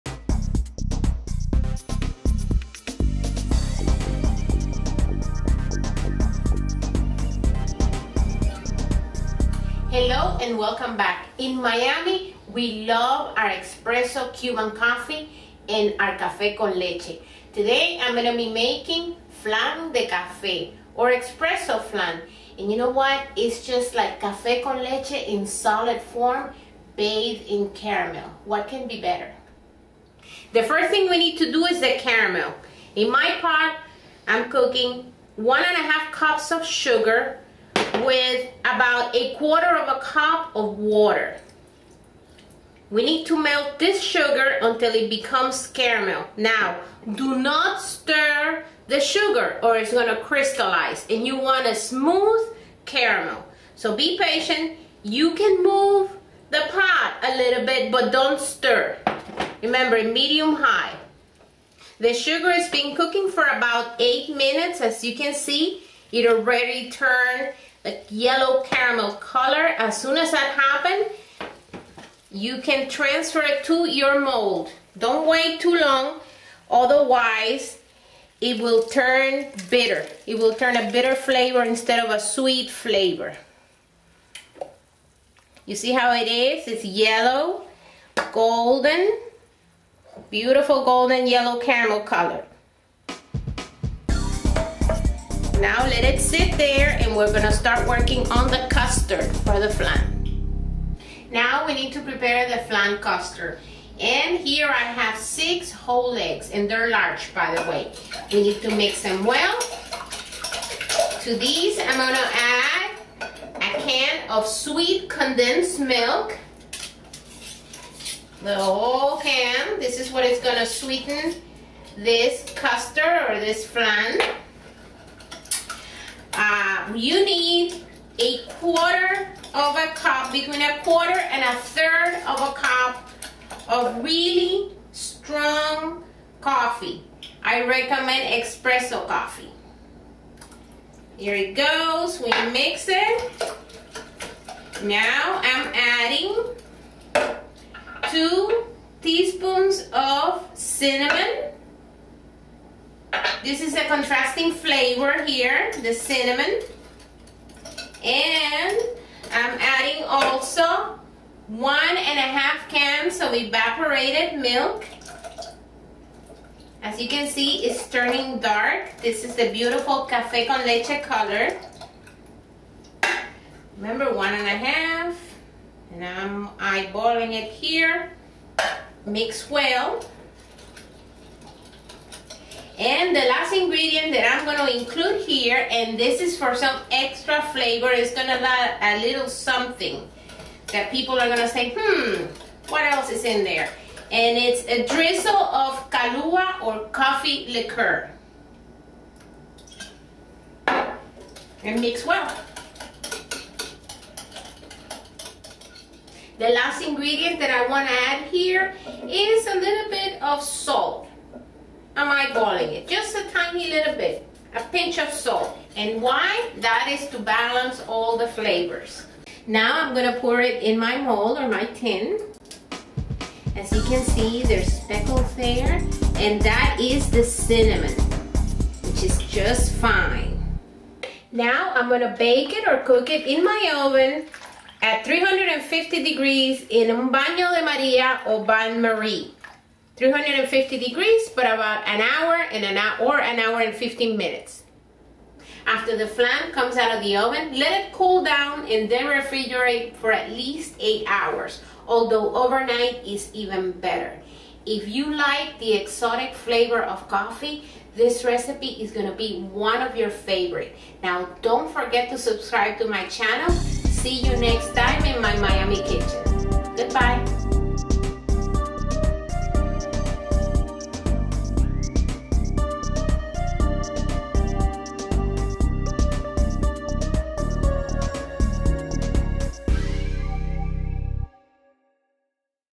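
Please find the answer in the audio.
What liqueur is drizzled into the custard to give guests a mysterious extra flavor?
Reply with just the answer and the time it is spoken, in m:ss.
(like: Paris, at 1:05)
Kahlua, at 3:15.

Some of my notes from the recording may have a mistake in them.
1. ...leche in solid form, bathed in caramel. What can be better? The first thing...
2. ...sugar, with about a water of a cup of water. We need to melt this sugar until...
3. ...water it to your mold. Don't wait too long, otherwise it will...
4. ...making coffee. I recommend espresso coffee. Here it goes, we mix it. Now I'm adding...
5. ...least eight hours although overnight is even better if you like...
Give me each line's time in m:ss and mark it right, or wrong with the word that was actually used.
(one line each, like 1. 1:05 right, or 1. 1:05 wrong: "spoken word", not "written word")
1. 0:24 right
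2. 0:36 wrong: "quarter", not "water"
3. 1:12 wrong: "transfer", not "water"
4. 2:14 wrong: "strong", not "making"
5. 4:10 right.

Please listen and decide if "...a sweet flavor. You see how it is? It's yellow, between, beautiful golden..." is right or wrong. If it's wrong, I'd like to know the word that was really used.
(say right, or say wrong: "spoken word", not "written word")
wrong: "golden", not "between".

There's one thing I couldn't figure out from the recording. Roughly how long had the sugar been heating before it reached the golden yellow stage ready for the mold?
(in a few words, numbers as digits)
8 minutes.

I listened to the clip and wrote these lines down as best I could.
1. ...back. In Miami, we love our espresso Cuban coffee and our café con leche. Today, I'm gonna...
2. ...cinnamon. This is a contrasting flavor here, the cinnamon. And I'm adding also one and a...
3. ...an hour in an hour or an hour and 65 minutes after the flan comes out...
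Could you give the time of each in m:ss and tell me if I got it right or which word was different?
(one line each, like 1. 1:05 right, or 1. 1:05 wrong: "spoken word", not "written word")
1. 0:10 right
2. 2:30 right
3. 4:01 wrong: "15", not "65".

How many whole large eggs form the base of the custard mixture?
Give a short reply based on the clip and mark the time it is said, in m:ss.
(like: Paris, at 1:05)
6, at 1:45.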